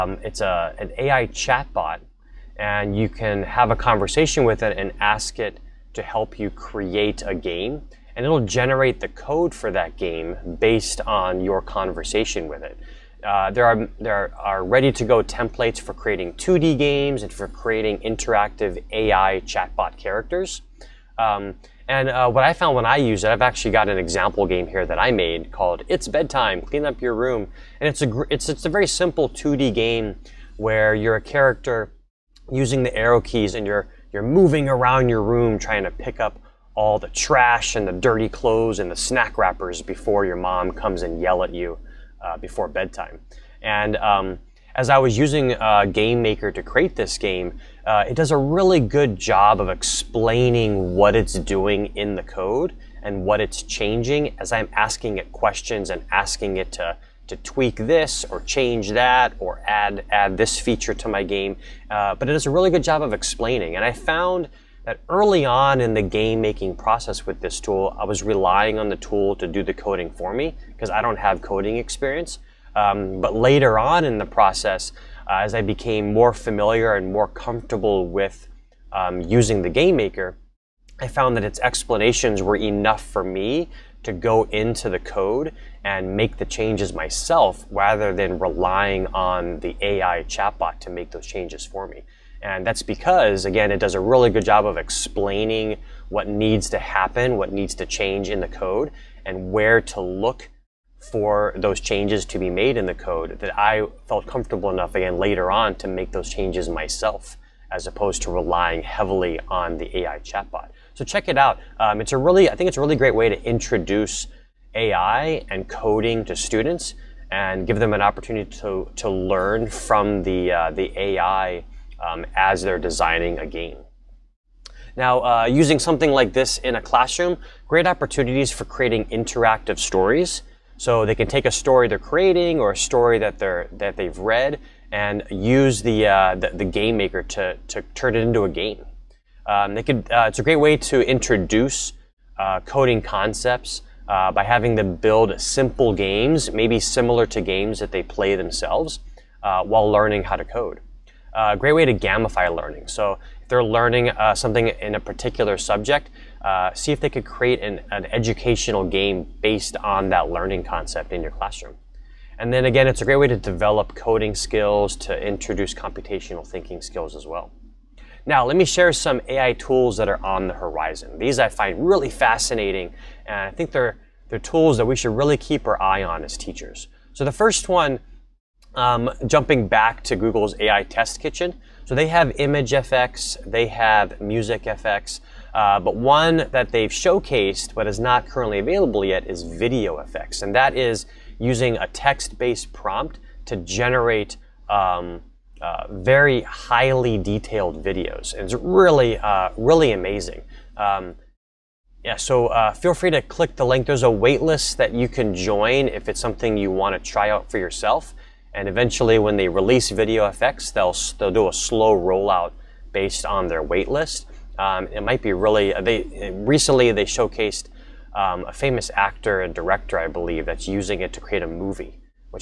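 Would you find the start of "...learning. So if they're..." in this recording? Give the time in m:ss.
2:32.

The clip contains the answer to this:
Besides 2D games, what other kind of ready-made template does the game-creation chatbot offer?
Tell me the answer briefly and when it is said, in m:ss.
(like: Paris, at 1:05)
Interactive AI chatbot characters, at 0:17.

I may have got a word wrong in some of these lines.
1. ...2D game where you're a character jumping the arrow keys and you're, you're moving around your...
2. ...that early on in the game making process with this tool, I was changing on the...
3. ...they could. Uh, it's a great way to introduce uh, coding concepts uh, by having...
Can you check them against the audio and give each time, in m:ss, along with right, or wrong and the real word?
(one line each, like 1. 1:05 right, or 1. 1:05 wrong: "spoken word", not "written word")
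1. 0:29 wrong: "using", not "jumping"
2. 1:04 wrong: "relying", not "changing"
3. 2:19 right.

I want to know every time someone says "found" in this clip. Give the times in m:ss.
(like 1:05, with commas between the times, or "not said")
0:22, 1:03, 1:21.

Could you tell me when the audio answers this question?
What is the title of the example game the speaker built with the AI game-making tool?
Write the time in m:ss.
0:25.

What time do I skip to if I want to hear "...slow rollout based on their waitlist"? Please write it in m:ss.
3:31.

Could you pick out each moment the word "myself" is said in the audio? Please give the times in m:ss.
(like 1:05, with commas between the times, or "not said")
1:26, 1:46.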